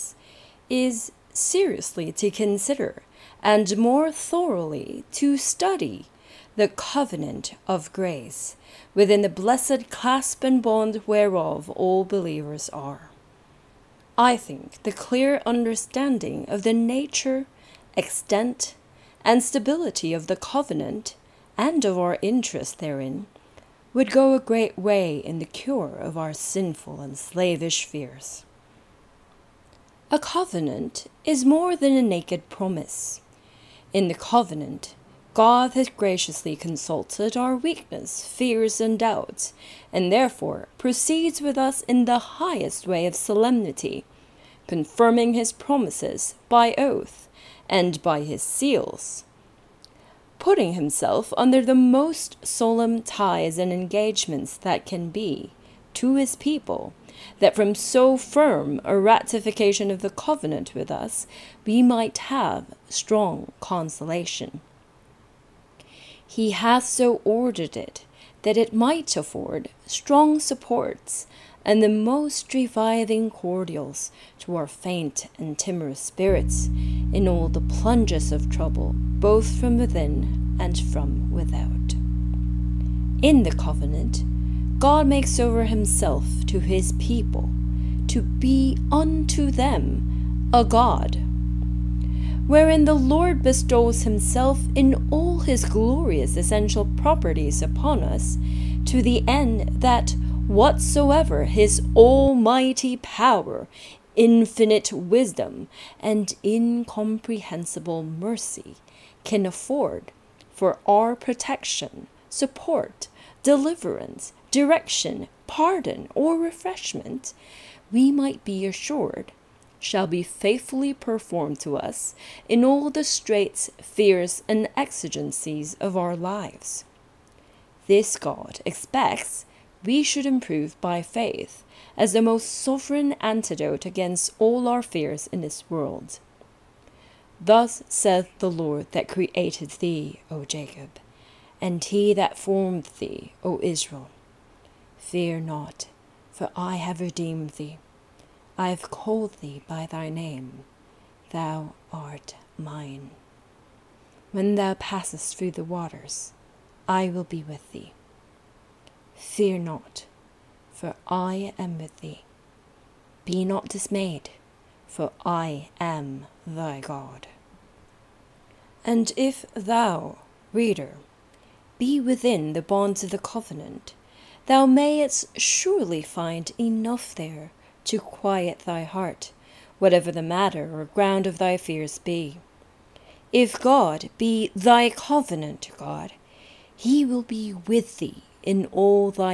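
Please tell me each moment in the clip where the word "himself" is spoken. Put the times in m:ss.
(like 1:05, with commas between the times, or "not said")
0:50, 1:25, 1:34.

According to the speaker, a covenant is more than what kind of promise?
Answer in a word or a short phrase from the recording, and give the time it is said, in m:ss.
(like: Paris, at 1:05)
A naked promise, at 0:31.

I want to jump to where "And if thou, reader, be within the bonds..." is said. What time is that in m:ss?
2:48.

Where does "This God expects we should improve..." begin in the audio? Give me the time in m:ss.
2:07.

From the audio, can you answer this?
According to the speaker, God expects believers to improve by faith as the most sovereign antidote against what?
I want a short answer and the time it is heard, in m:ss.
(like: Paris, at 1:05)
All our fears, at 2:14.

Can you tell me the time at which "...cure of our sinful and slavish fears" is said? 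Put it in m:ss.
0:25.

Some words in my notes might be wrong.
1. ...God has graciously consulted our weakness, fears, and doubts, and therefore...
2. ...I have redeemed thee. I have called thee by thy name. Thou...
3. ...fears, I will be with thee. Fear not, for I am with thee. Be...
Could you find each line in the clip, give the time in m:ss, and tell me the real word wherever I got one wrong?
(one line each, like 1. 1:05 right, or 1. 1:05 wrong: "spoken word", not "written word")
1. 0:35 right
2. 2:26 right
3. 2:35 wrong: "waters", not "fears".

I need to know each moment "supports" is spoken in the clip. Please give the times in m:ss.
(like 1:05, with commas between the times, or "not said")
1:10, 1:52.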